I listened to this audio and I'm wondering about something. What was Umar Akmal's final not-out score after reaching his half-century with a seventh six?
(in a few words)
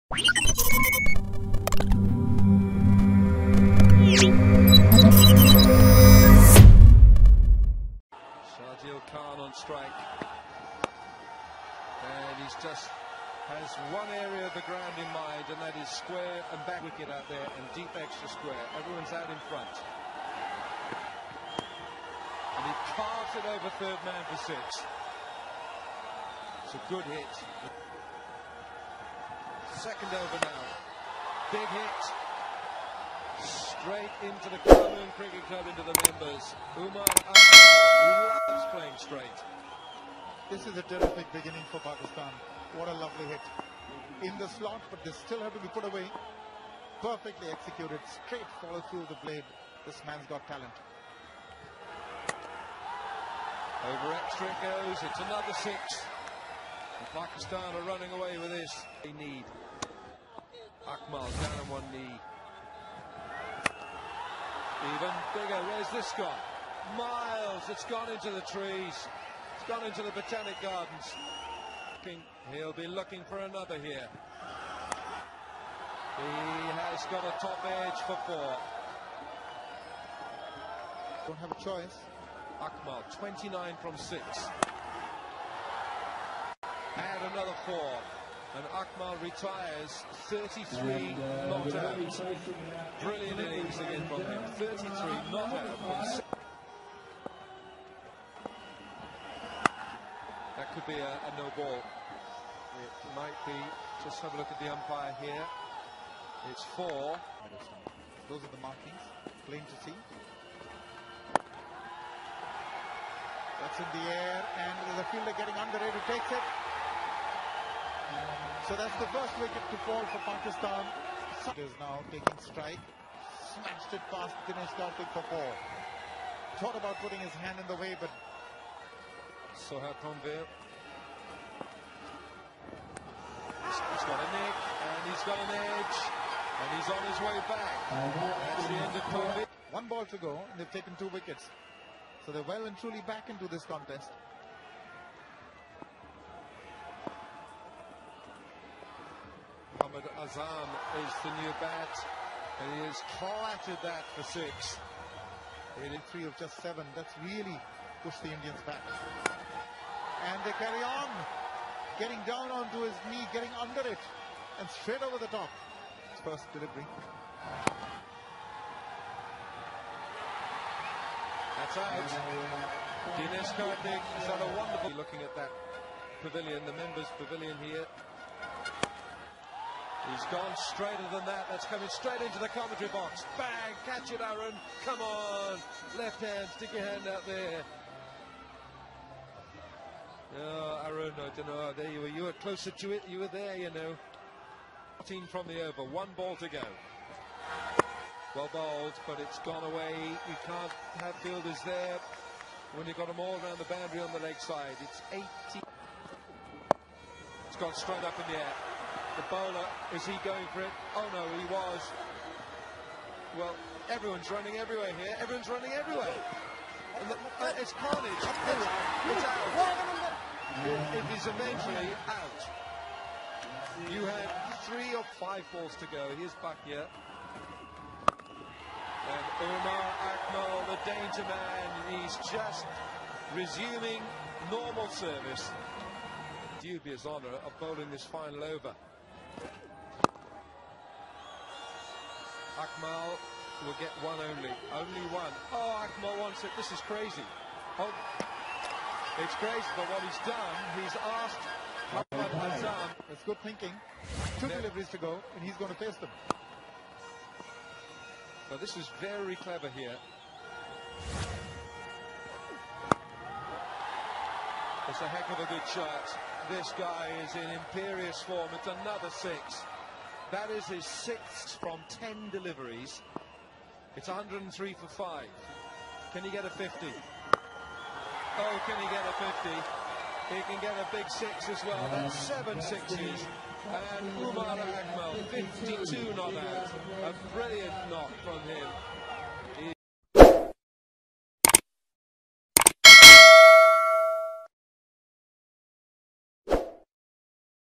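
52.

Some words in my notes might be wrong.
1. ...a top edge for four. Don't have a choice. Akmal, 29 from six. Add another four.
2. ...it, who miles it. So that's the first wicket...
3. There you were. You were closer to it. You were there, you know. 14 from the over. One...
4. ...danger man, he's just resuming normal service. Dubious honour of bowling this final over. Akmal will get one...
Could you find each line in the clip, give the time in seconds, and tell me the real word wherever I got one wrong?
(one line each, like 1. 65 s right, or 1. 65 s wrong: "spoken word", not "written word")
1. 77 s right
2. 115 s wrong: "takes", not "miles"
3. 191 s right
4. 230 s right.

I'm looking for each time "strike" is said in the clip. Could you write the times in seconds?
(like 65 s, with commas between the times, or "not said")
9 s, 122 s.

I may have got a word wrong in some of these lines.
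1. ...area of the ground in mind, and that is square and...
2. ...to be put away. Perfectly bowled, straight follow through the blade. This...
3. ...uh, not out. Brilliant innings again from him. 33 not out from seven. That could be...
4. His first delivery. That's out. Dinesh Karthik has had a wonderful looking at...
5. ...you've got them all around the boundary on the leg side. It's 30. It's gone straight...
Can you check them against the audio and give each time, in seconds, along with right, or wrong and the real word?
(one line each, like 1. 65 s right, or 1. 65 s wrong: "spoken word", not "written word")
1. 14 s right
2. 45 s wrong: "executed", not "bowled"
3. 91 s wrong: "six", not "seven"
4. 166 s right
5. 202 s wrong: "80", not "30".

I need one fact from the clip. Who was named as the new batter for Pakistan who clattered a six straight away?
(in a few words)
Mohammad Azam.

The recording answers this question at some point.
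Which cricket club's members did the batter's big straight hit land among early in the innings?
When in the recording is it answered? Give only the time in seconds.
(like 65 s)
34 s.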